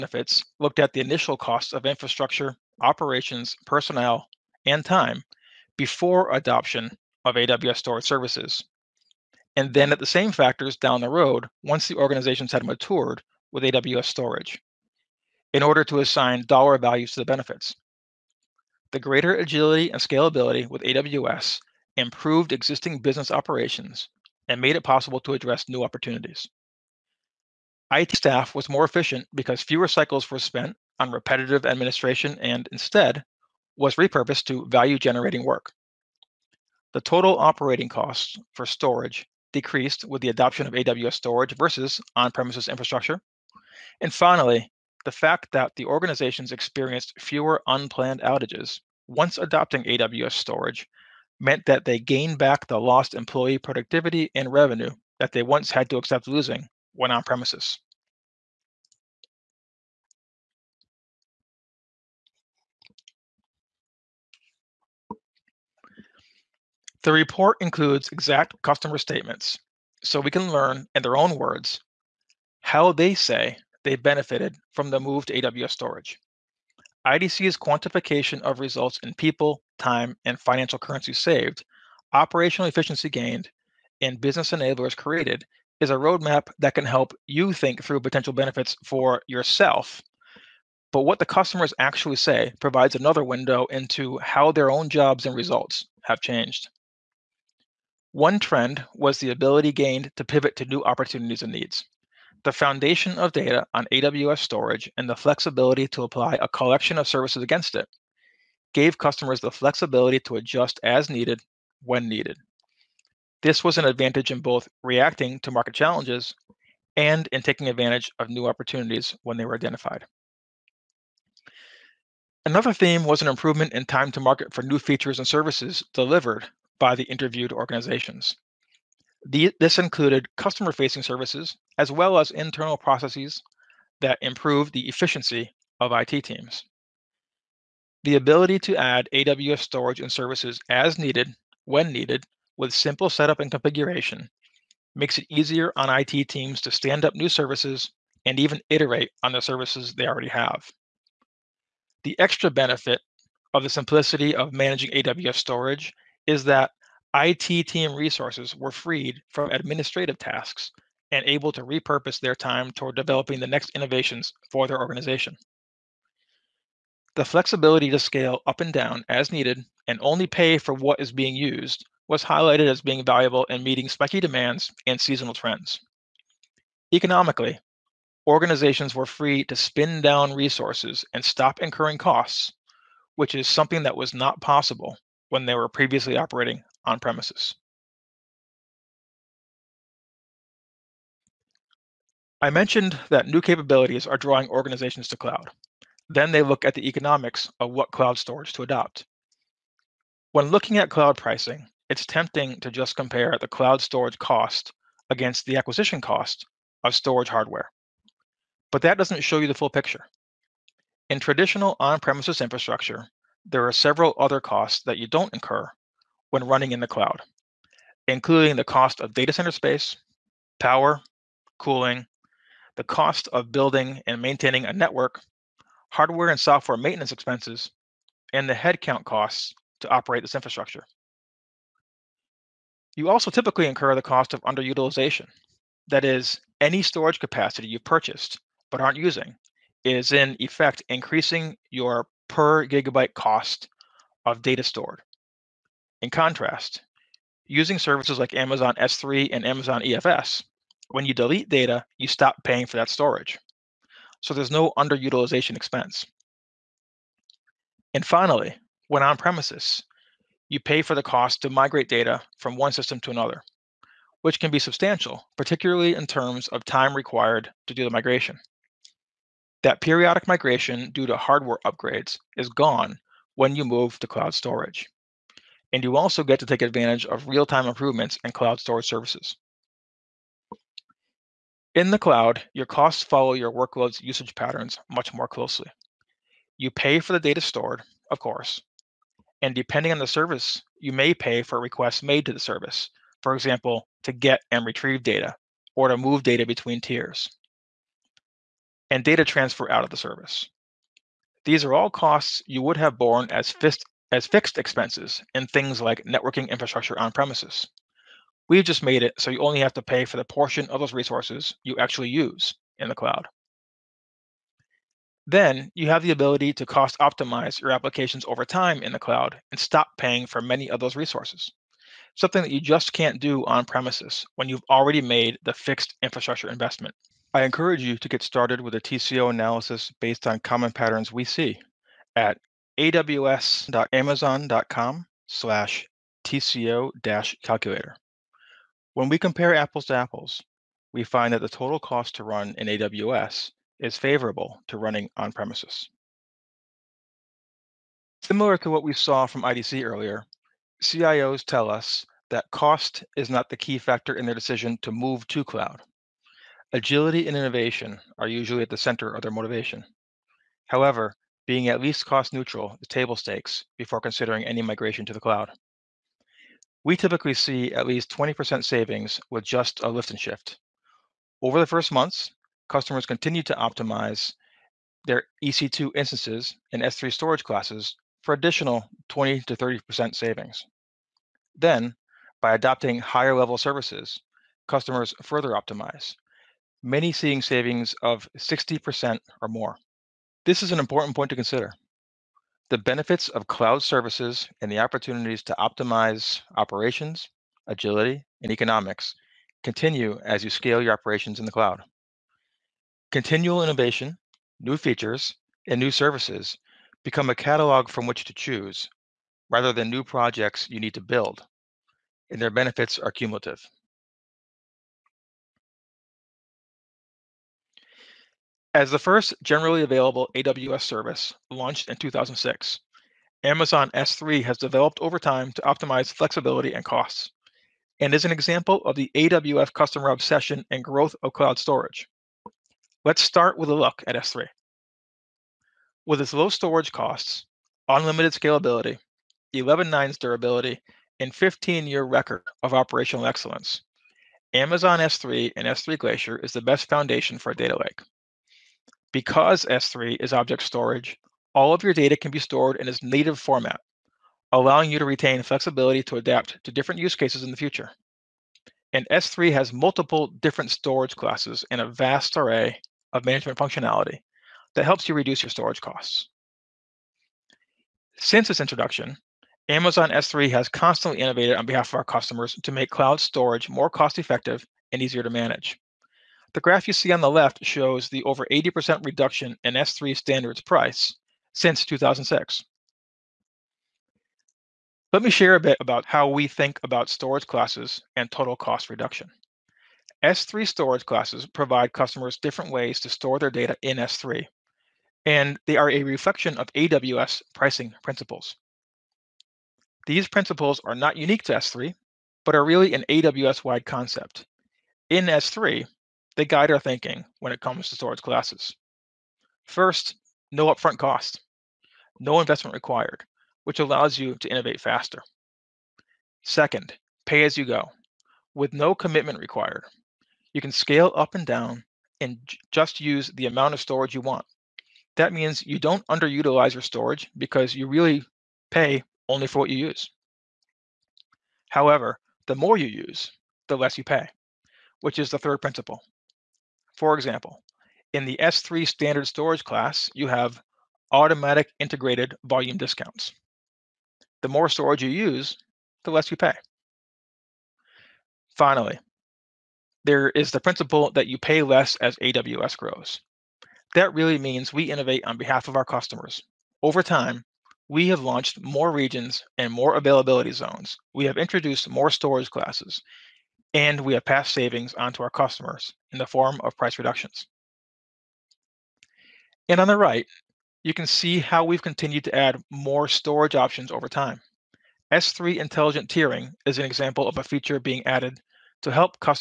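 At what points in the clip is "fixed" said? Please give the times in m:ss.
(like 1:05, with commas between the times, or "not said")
5:04, 5:25.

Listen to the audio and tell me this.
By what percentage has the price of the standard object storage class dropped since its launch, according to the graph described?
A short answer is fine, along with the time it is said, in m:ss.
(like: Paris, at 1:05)
over 80%, at 7:58.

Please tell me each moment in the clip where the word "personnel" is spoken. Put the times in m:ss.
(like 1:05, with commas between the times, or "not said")
0:03.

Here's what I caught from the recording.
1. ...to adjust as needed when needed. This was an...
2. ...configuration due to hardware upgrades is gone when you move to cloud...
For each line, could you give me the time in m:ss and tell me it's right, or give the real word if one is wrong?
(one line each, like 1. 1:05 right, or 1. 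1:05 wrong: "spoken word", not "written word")
1. 1:50 right
2. 4:30 wrong: "migration", not "configuration".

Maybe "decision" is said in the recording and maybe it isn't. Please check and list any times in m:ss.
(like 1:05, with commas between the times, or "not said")
5:54.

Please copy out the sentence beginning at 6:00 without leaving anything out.
However, being at least cost neutral is table stakes before considering any migration to the cloud.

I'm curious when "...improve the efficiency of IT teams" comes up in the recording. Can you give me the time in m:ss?
2:14.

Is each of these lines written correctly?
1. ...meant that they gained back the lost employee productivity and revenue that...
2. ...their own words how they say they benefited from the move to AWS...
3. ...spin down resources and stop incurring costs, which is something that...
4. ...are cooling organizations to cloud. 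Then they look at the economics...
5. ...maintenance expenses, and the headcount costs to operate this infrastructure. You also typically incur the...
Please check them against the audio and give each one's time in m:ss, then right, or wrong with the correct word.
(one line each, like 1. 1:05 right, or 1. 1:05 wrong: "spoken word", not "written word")
1. 0:51 right
2. 1:11 right
3. 2:59 right
4. 3:14 wrong: "drawing", not "cooling"
5. 3:46 right.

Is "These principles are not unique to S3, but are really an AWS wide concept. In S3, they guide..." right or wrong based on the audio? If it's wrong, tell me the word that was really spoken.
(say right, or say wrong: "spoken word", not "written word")
right.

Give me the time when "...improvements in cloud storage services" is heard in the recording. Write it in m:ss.
4:37.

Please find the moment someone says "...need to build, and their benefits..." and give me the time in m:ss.
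6:50.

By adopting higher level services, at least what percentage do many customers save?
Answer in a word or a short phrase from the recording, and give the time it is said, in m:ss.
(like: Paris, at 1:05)
60%, at 6:28.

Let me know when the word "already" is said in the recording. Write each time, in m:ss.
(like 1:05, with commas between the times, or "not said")
2:30, 5:24.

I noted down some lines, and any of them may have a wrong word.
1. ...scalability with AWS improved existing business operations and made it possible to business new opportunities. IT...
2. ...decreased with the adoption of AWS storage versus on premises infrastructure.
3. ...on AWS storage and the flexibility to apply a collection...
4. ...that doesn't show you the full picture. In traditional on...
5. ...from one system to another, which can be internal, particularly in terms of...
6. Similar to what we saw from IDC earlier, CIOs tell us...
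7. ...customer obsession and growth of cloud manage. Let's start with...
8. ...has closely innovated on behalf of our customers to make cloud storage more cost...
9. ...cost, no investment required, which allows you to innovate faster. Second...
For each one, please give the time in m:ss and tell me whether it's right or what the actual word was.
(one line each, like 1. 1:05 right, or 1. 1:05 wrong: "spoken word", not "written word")
1. 0:19 wrong: "address", not "business"
2. 0:39 right
3. 1:43 right
4. 3:28 right
5. 4:22 wrong: "substantial", not "internal"
6. 5:48 right
7. 7:09 wrong: "storage", not "manage"
8. 7:50 wrong: "constantly", not "closely"
9. 8:30 right.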